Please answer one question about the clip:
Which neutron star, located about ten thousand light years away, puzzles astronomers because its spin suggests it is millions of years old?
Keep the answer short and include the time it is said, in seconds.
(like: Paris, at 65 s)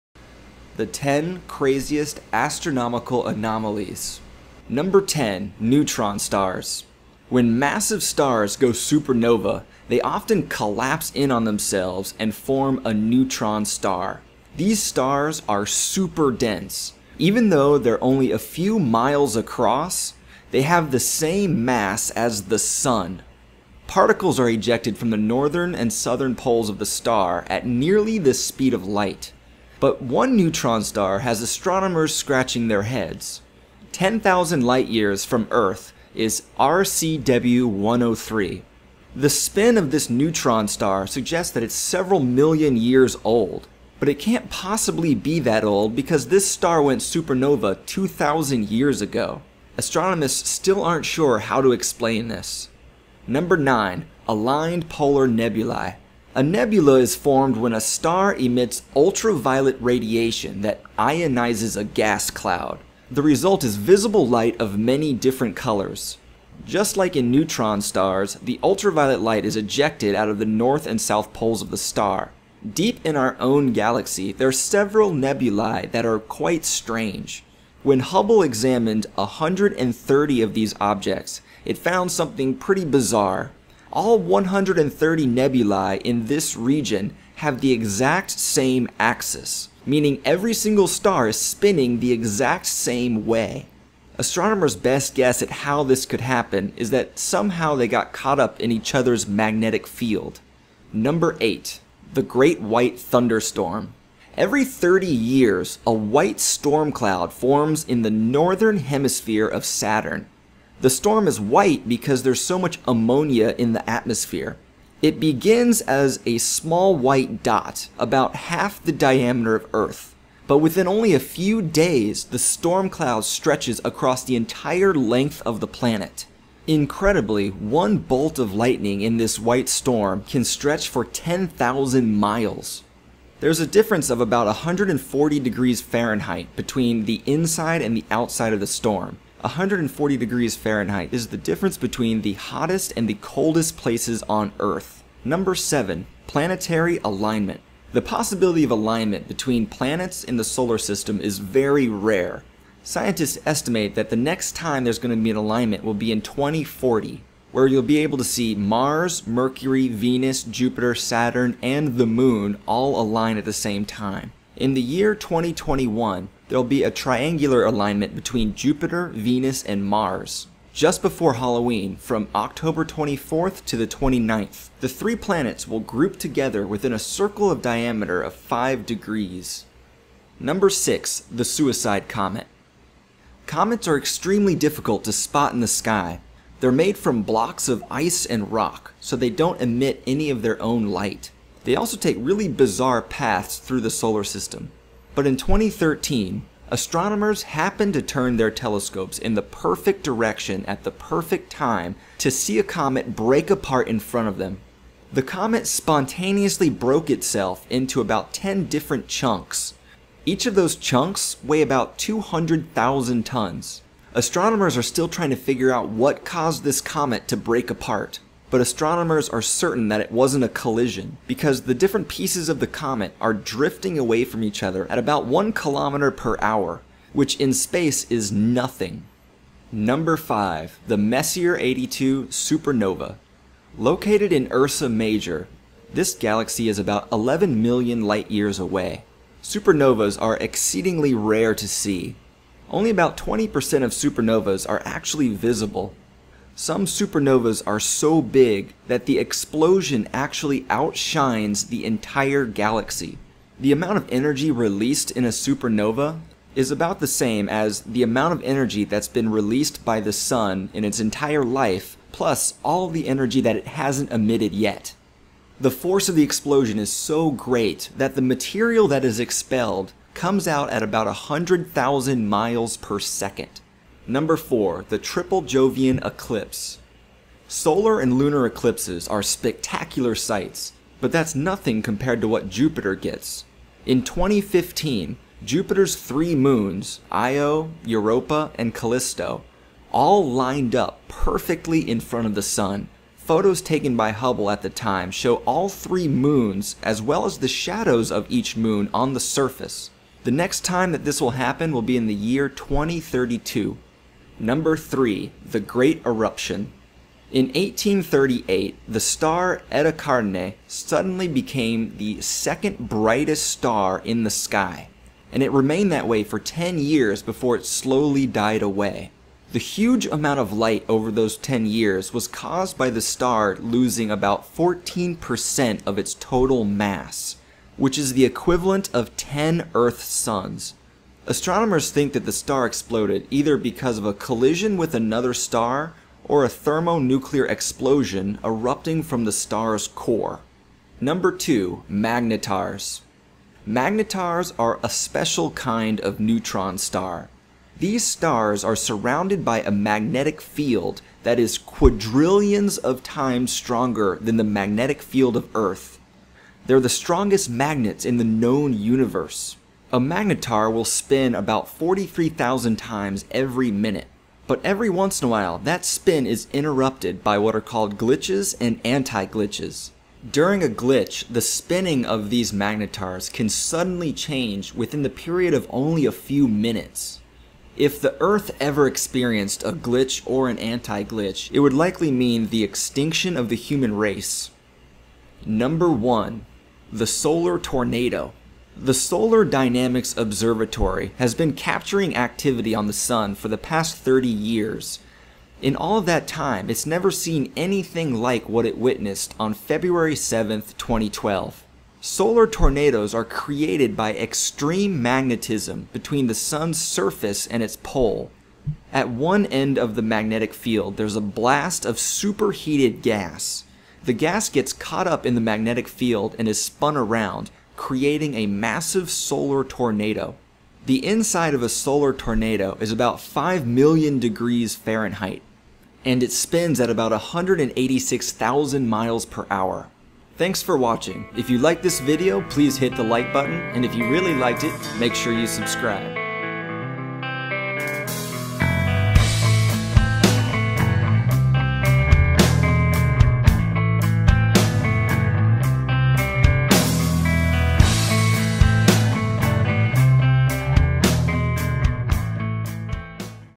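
RCW 103, at 36 s.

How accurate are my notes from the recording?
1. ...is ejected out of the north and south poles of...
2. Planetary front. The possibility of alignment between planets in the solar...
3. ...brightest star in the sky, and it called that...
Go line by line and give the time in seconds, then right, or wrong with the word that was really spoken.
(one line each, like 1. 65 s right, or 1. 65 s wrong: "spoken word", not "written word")
1. 69 s right
2. 146 s wrong: "alignment", not "front"
3. 312 s wrong: "remained", not "called".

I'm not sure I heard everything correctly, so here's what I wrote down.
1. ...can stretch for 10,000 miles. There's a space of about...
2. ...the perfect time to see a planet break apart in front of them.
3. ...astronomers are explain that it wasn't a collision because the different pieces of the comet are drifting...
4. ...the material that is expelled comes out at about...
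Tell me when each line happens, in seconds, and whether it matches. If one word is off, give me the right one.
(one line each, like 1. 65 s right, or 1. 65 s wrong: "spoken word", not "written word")
1. 130 s wrong: "difference", not "space"
2. 200 s wrong: "comet", not "planet"
3. 218 s wrong: "certain", not "explain"
4. 268 s right.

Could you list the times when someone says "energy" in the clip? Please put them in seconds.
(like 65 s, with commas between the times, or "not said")
254 s, 258 s, 263 s.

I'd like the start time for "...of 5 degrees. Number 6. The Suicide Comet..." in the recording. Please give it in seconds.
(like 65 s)
178 s.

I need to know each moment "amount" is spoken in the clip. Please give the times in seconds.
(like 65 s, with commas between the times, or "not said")
253 s, 258 s, 320 s.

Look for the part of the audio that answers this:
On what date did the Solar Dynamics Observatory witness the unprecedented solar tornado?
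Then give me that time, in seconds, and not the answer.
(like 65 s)
399 s.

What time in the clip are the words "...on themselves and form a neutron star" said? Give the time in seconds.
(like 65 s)
11 s.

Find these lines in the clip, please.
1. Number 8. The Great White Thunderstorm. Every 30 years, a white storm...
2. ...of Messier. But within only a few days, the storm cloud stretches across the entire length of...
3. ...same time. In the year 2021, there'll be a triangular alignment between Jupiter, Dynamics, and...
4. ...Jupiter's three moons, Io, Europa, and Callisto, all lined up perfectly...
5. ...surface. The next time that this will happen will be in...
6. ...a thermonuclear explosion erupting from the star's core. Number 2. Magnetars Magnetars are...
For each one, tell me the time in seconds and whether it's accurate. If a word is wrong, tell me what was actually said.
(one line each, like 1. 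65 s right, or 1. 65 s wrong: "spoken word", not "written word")
1. 100 s right
2. 119 s wrong: "Earth", not "Messier"
3. 163 s wrong: "Venus", not "Dynamics"
4. 285 s right
5. 299 s right
6. 336 s right.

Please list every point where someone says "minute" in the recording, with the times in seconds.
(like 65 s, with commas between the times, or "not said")
363 s, 376 s.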